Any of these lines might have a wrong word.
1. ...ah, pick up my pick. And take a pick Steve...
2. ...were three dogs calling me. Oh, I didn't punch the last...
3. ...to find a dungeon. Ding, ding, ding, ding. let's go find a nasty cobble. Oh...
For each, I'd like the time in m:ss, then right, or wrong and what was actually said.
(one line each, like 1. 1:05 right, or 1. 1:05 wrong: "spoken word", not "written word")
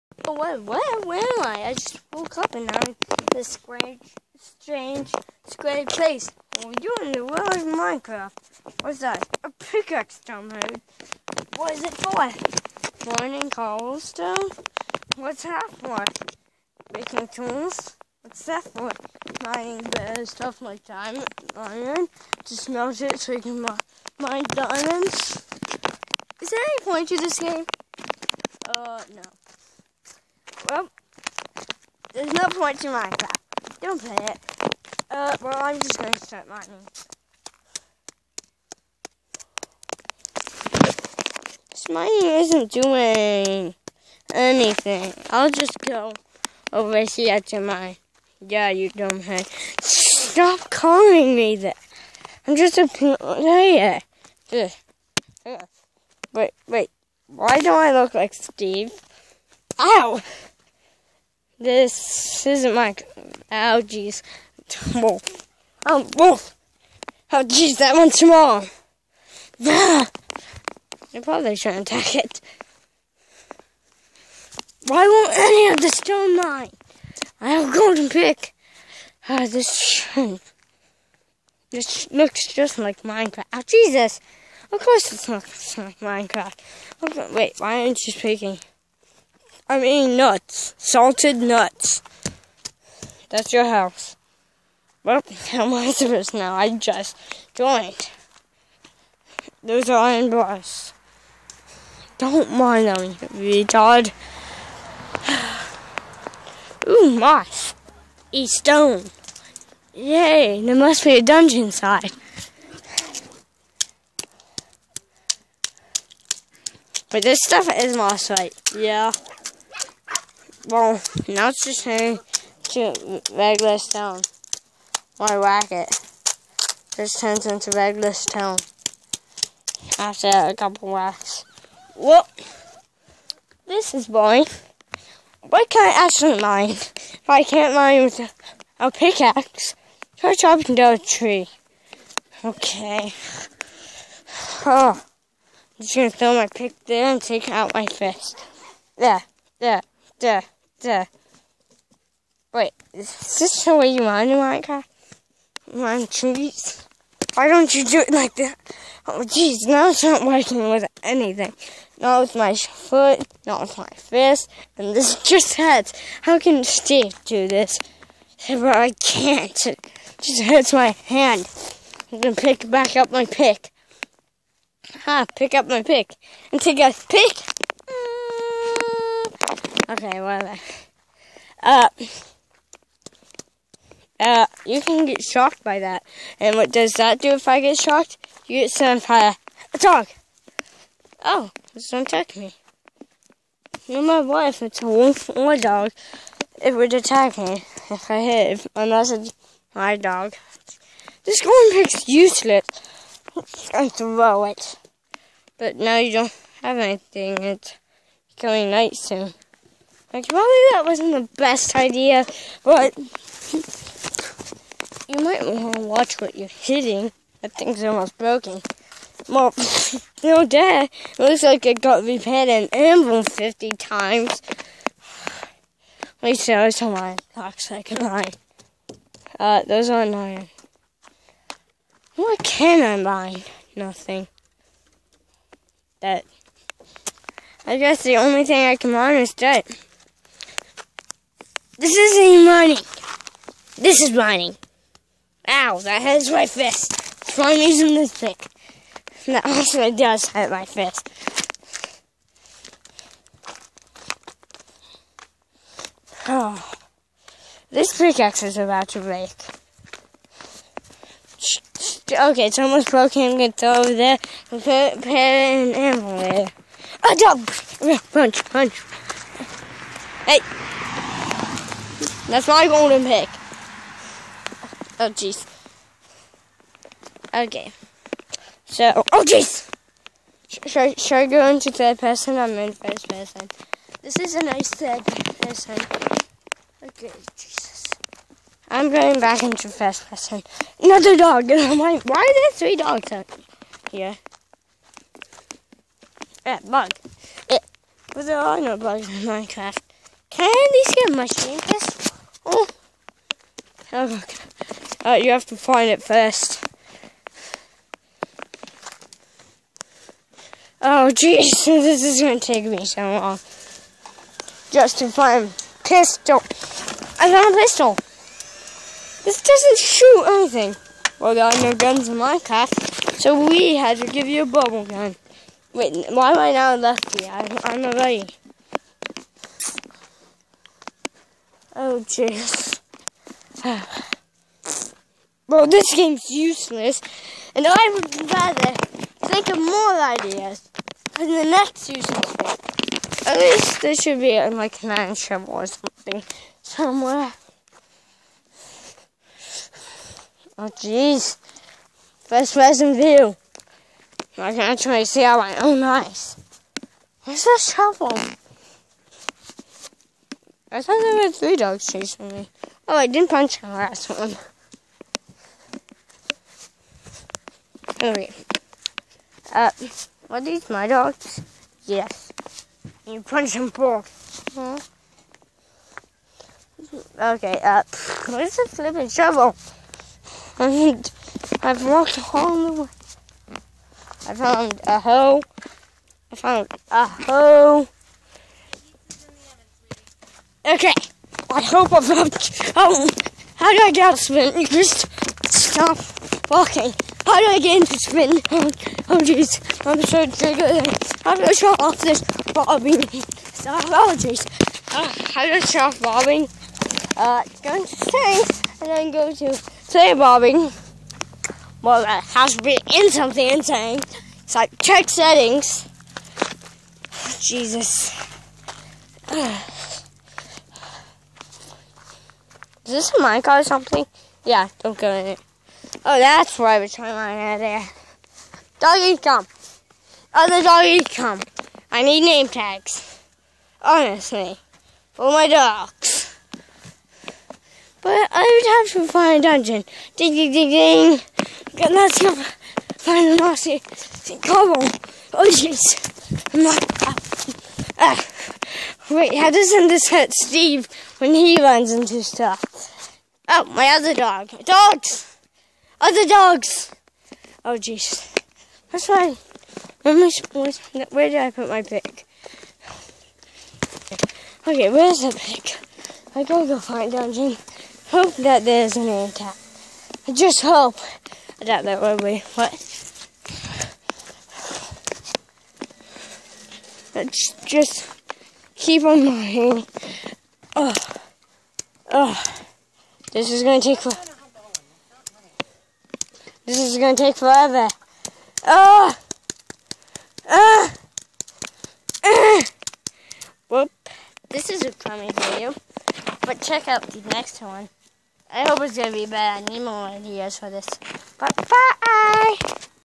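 1. 2:55 wrong: "Okay", not "Steve"
2. 6:01 wrong: "chasing", not "calling"
3. 7:19 right.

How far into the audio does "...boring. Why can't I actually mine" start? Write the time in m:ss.
2:14.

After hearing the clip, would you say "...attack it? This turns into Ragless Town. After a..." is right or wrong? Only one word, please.
wrong.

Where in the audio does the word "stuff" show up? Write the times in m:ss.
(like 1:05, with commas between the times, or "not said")
0:20, 1:57, 7:32.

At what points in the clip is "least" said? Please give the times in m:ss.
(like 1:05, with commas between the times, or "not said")
3:46, 5:43.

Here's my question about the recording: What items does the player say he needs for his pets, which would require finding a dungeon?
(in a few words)
Name tags.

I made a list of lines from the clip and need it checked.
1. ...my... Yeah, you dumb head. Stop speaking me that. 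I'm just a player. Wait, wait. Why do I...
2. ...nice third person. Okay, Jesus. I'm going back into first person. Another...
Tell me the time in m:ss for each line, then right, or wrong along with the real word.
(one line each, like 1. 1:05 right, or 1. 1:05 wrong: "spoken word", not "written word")
1. 0:47 wrong: "calling", not "speaking"
2. 4:44 right.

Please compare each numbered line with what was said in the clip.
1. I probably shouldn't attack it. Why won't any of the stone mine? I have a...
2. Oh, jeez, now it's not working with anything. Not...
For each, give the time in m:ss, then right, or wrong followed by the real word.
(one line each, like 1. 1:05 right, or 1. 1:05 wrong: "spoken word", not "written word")
1. 1:11 right
2. 2:39 right.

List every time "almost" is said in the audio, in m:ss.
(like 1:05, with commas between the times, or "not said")
3:37, 4:22.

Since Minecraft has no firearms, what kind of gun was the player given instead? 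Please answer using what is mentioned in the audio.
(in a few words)
Bubble gun.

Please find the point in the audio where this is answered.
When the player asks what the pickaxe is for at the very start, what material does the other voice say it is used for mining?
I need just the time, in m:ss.
0:13.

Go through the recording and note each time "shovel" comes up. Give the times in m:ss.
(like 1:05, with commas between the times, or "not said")
5:45, 5:57, 6:19.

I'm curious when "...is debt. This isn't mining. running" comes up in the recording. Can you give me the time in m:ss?
3:59.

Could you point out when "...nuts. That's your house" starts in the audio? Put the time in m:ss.
1:31.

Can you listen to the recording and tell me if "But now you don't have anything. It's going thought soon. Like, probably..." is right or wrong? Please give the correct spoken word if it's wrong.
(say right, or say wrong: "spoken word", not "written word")
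wrong: "night", not "thought".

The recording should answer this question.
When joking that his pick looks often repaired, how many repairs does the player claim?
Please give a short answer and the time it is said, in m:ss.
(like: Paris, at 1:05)
50, at 3:43.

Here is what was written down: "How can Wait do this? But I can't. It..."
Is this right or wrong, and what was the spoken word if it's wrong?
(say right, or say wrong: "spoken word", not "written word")
wrong: "Steve", not "Wait".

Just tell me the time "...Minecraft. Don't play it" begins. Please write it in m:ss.
0:32.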